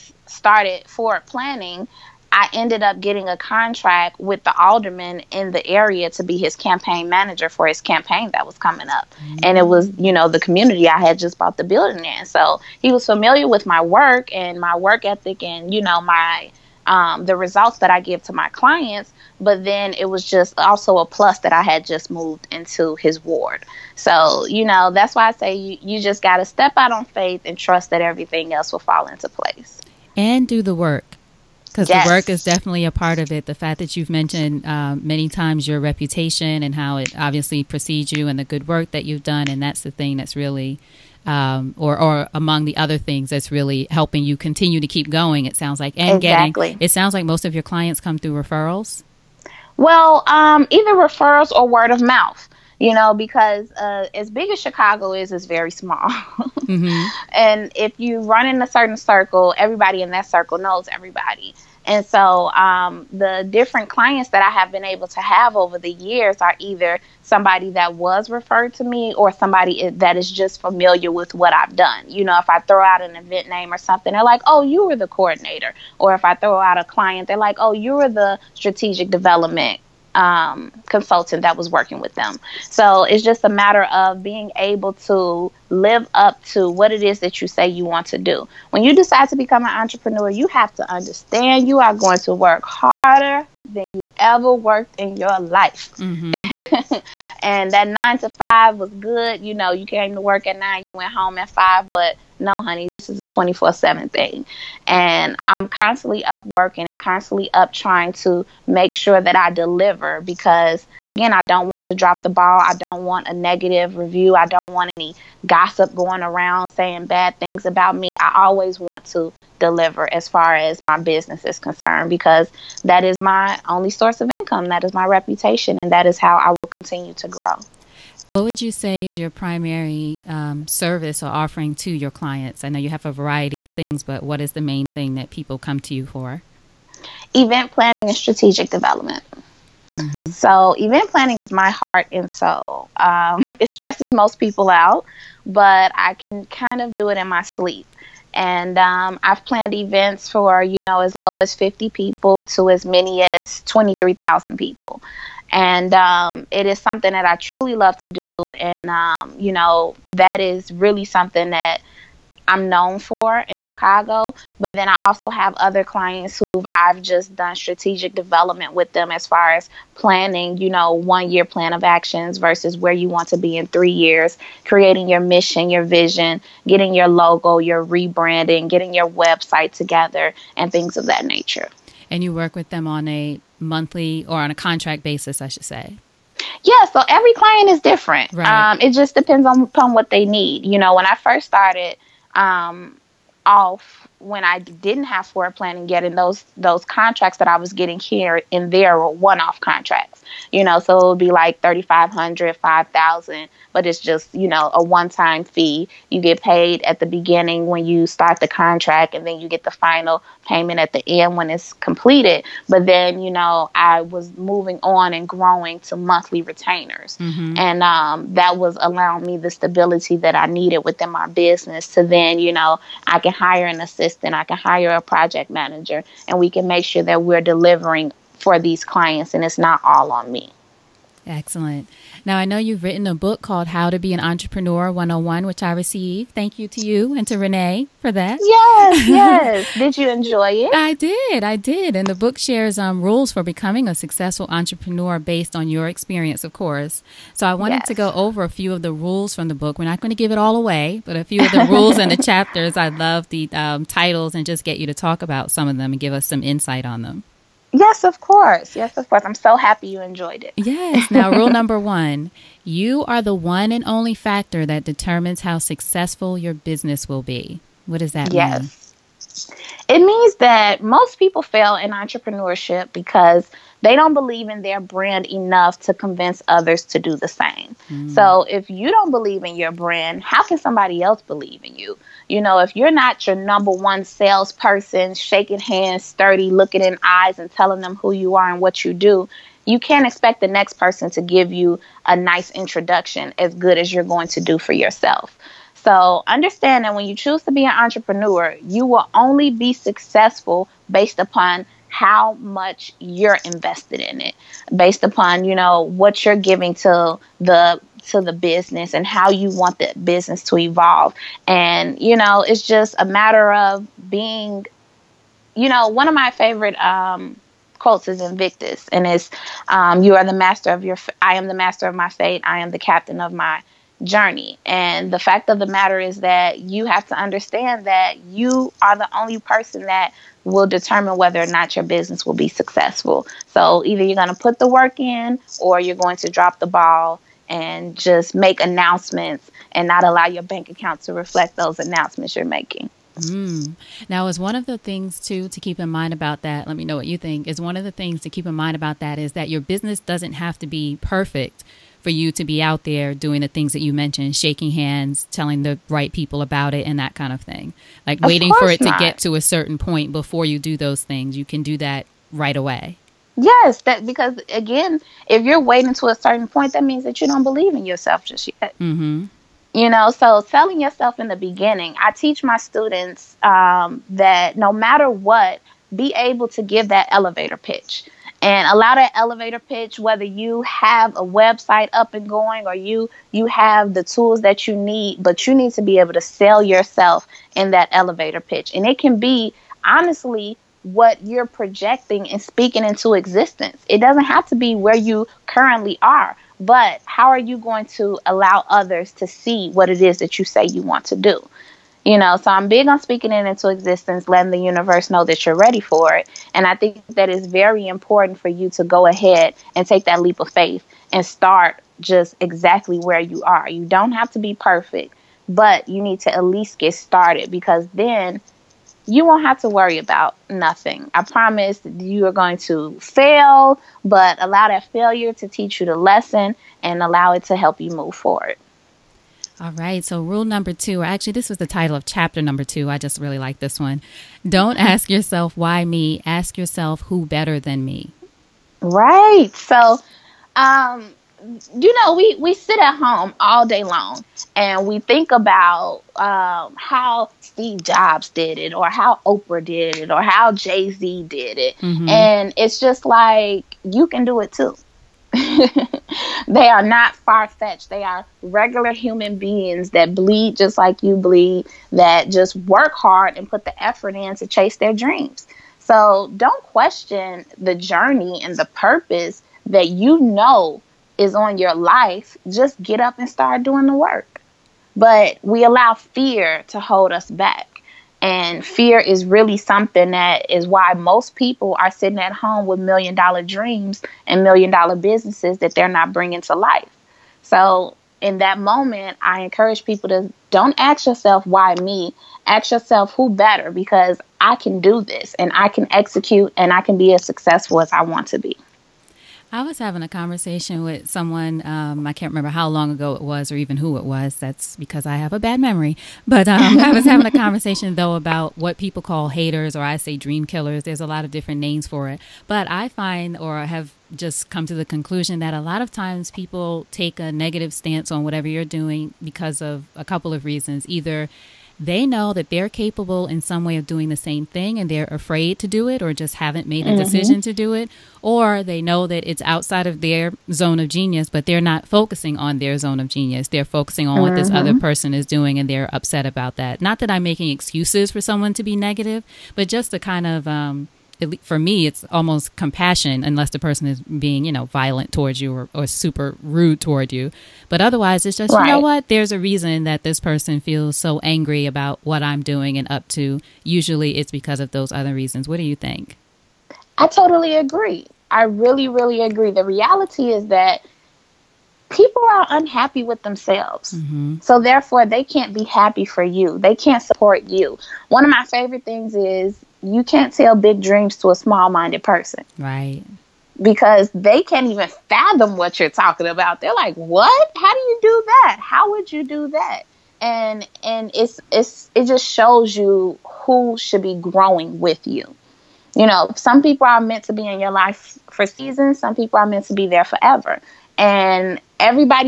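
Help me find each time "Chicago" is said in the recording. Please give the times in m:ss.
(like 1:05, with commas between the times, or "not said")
0:54, 2:43.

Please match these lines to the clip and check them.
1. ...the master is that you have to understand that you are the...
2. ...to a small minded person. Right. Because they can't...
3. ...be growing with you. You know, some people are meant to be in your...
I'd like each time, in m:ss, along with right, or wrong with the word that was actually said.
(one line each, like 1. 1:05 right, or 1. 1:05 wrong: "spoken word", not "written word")
1. 5:25 wrong: "matter", not "master"
2. 9:31 right
3. 9:44 right.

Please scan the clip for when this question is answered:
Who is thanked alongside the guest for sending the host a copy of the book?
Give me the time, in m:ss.
3:57.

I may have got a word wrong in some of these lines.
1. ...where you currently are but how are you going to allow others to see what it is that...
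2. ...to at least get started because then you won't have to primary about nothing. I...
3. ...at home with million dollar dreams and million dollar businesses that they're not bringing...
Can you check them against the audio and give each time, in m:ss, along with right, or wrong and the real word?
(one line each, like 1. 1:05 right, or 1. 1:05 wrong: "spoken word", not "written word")
1. 6:34 right
2. 6:56 wrong: "worry", not "primary"
3. 8:02 right.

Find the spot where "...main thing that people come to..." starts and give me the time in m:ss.
2:14.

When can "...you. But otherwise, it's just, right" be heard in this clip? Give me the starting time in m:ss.
9:07.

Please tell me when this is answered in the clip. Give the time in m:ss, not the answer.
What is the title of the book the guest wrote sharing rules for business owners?
3:53.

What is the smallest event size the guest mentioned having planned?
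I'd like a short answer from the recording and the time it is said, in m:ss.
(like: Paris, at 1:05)
50, at 2:31.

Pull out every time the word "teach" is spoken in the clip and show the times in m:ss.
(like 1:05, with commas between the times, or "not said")
6:12, 7:05.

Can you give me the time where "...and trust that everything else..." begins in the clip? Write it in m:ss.
0:27.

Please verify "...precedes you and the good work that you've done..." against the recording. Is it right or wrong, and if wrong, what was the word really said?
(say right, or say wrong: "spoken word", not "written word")
right.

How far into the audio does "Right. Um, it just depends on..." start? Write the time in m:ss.
3:08.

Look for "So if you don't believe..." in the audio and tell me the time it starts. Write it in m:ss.
4:38.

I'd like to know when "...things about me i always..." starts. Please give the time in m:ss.
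1:57.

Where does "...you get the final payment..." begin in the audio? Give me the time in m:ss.
3:29.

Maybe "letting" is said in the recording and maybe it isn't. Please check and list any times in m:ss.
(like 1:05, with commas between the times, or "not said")
6:44.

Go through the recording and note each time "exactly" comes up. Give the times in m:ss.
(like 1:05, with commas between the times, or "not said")
0:46, 6:52.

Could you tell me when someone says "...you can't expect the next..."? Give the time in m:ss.
4:49.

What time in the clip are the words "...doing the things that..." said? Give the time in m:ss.
5:53.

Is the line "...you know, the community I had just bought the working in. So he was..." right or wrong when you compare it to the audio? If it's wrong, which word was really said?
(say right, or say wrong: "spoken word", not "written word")
wrong: "building", not "working".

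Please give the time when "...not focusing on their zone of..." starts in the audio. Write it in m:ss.
8:51.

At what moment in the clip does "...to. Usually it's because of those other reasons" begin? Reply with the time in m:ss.
9:13.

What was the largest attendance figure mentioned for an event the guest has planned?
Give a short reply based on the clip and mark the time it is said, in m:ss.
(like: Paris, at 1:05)
23,000, at 2:33.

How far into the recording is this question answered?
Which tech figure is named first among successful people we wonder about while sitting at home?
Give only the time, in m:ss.
7:27.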